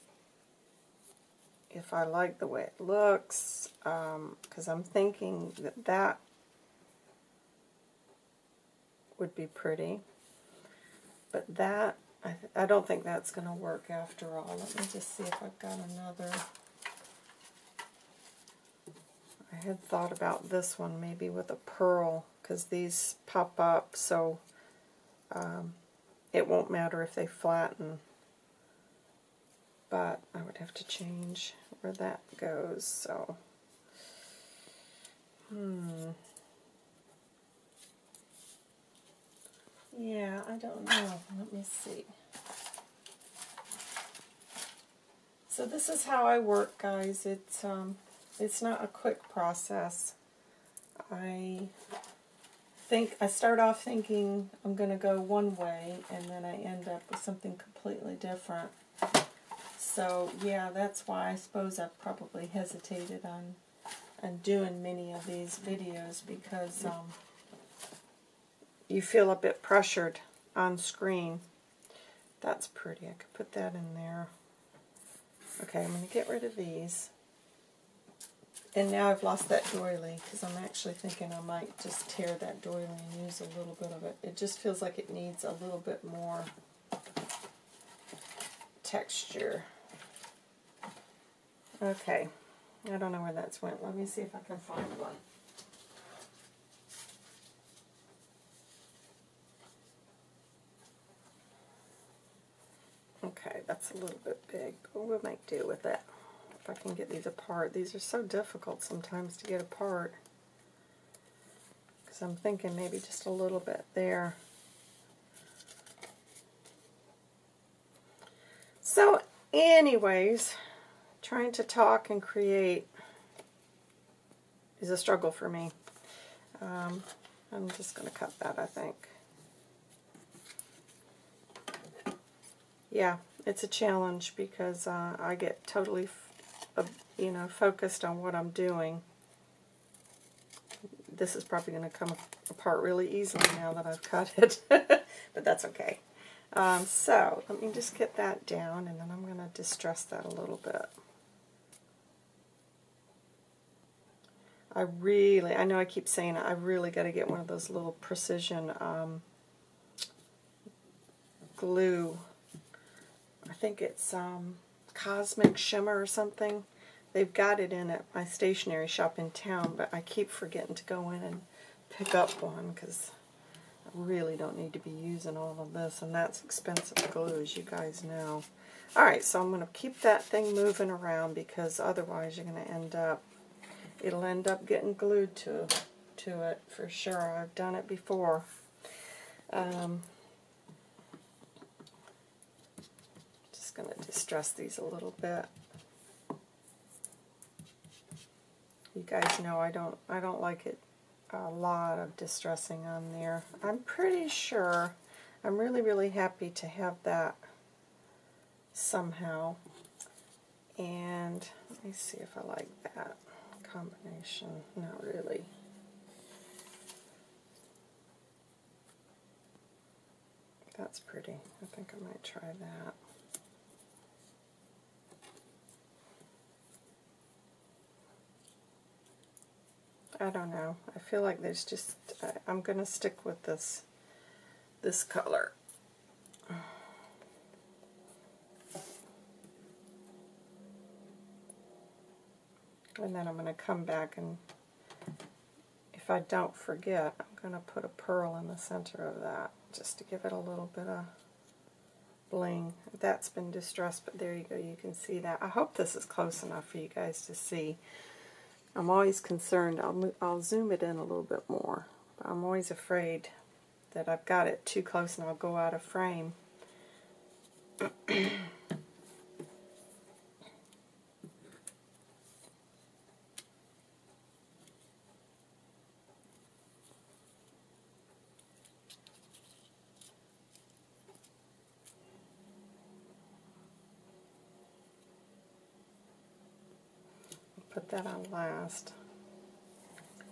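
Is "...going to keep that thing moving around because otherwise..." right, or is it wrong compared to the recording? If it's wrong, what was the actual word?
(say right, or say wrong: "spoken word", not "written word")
right.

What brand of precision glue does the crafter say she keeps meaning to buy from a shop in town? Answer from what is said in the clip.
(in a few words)
Cosmic Shimmer.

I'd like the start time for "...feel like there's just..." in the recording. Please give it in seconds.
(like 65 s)
230 s.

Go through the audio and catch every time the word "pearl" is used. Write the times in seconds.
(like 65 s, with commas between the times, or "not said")
21 s, 247 s.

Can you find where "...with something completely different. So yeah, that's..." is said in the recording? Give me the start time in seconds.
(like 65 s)
57 s.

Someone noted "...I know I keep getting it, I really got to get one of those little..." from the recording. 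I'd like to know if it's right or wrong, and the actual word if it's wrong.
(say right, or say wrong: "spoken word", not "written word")
wrong: "saying", not "getting".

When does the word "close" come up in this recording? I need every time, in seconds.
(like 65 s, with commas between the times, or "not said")
256 s, 264 s.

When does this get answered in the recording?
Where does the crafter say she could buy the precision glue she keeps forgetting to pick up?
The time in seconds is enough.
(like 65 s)
168 s.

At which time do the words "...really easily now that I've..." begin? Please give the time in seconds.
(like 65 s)
142 s.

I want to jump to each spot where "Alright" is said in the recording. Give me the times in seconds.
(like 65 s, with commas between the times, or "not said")
178 s.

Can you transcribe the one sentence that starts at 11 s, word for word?
But that I, I don't think that's going to work after all.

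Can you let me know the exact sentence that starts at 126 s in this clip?
Um, I'm just going to cut that, I think.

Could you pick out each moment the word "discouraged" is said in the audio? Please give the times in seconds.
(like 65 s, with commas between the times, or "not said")
not said.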